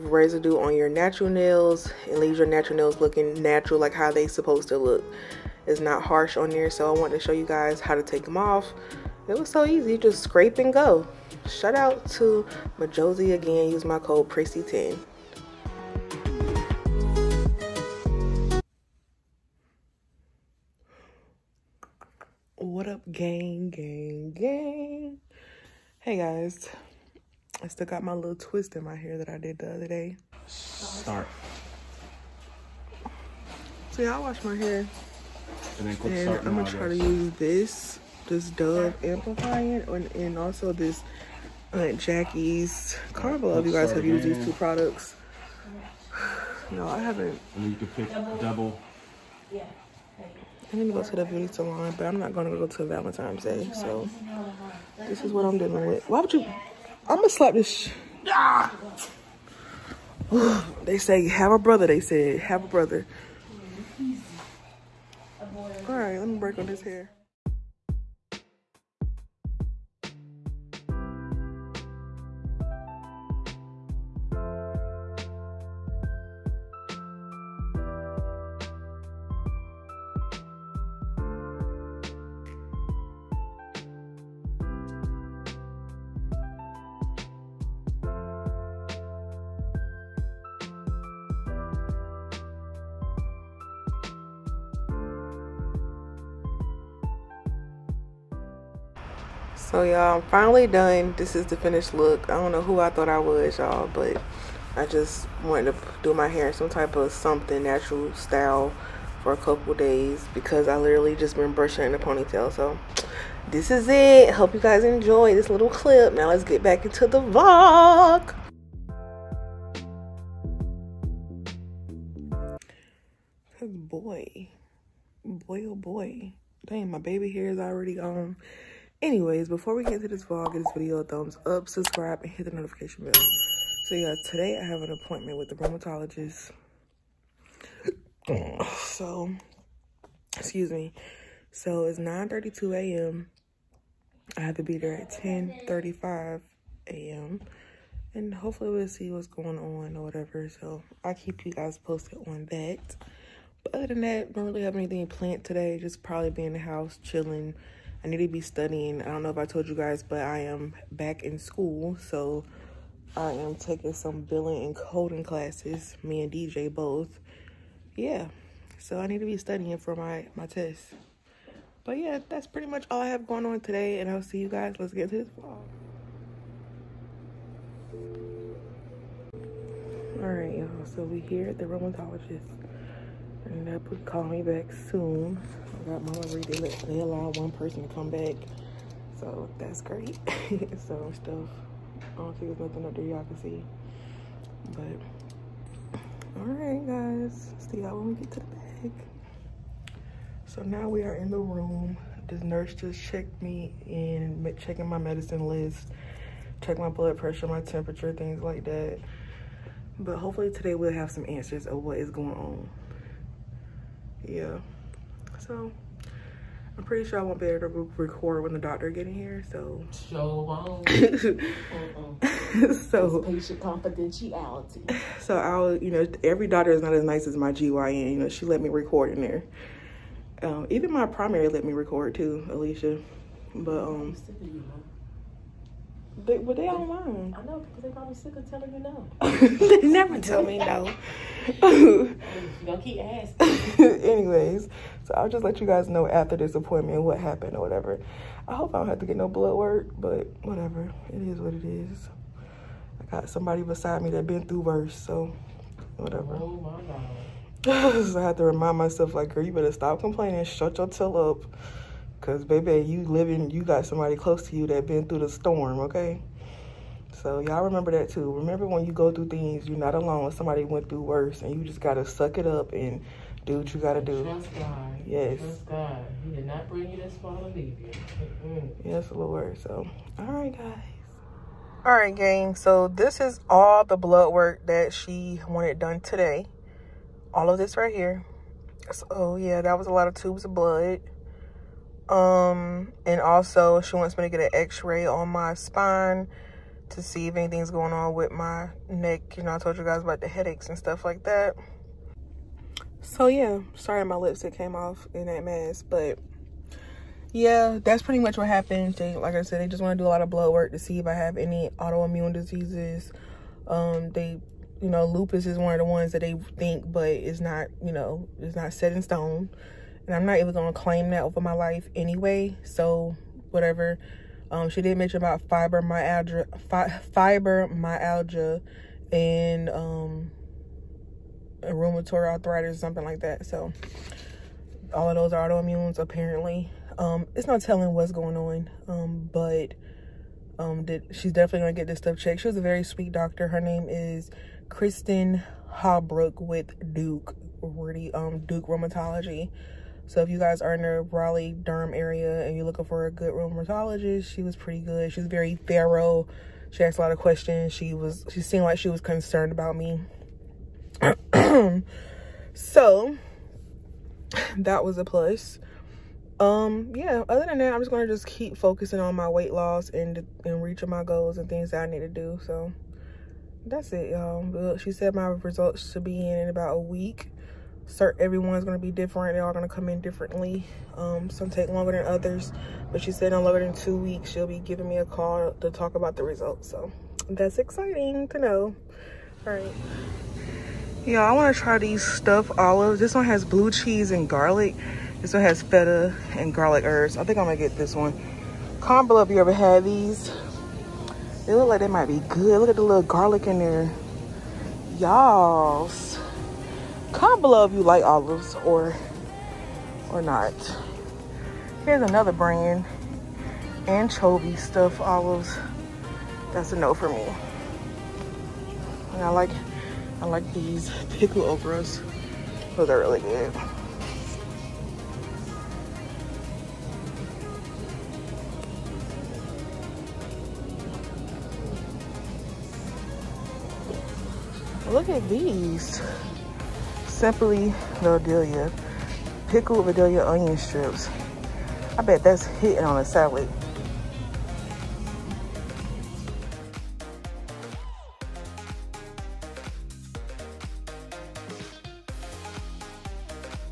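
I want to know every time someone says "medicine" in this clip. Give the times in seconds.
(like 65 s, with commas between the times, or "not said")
204 s.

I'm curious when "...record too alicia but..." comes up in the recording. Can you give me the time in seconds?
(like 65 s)
231 s.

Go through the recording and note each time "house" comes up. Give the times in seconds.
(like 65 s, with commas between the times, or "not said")
156 s.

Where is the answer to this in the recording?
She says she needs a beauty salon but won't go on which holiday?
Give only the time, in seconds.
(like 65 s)
52 s.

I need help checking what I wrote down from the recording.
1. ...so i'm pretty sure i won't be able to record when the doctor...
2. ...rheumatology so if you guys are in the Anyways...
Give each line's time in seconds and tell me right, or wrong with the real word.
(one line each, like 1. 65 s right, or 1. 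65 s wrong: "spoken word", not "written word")
1. 215 s right
2. 348 s wrong: "Raleigh", not "Anyways".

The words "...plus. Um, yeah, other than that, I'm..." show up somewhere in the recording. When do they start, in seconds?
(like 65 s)
365 s.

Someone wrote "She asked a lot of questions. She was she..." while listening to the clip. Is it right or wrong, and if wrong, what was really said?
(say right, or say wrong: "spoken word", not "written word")
right.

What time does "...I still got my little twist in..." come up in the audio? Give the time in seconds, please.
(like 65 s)
27 s.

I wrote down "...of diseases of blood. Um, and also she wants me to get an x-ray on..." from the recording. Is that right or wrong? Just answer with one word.
wrong.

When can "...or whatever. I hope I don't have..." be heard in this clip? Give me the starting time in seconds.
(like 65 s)
247 s.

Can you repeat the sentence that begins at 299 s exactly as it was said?
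You know, I told you guys about the headaches and stuff like that.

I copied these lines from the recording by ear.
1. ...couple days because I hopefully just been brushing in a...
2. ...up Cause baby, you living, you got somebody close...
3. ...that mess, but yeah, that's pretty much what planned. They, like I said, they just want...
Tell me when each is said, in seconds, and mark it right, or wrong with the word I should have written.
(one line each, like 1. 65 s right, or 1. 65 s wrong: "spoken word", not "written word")
1. 109 s wrong: "literally", not "hopefully"
2. 261 s right
3. 305 s wrong: "happened", not "planned".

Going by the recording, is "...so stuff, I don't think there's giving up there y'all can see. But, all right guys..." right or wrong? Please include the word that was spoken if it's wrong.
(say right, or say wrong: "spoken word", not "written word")
wrong: "nothing", not "giving".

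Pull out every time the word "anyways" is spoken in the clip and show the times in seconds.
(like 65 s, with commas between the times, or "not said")
129 s, 244 s, 321 s.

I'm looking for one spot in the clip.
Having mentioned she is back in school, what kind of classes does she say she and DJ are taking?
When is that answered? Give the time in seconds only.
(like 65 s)
164 s.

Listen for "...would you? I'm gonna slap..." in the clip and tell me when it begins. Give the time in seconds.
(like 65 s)
56 s.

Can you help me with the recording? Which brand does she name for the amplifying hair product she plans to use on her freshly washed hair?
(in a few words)
Dove.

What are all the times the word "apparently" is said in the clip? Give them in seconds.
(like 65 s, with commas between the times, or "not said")
335 s.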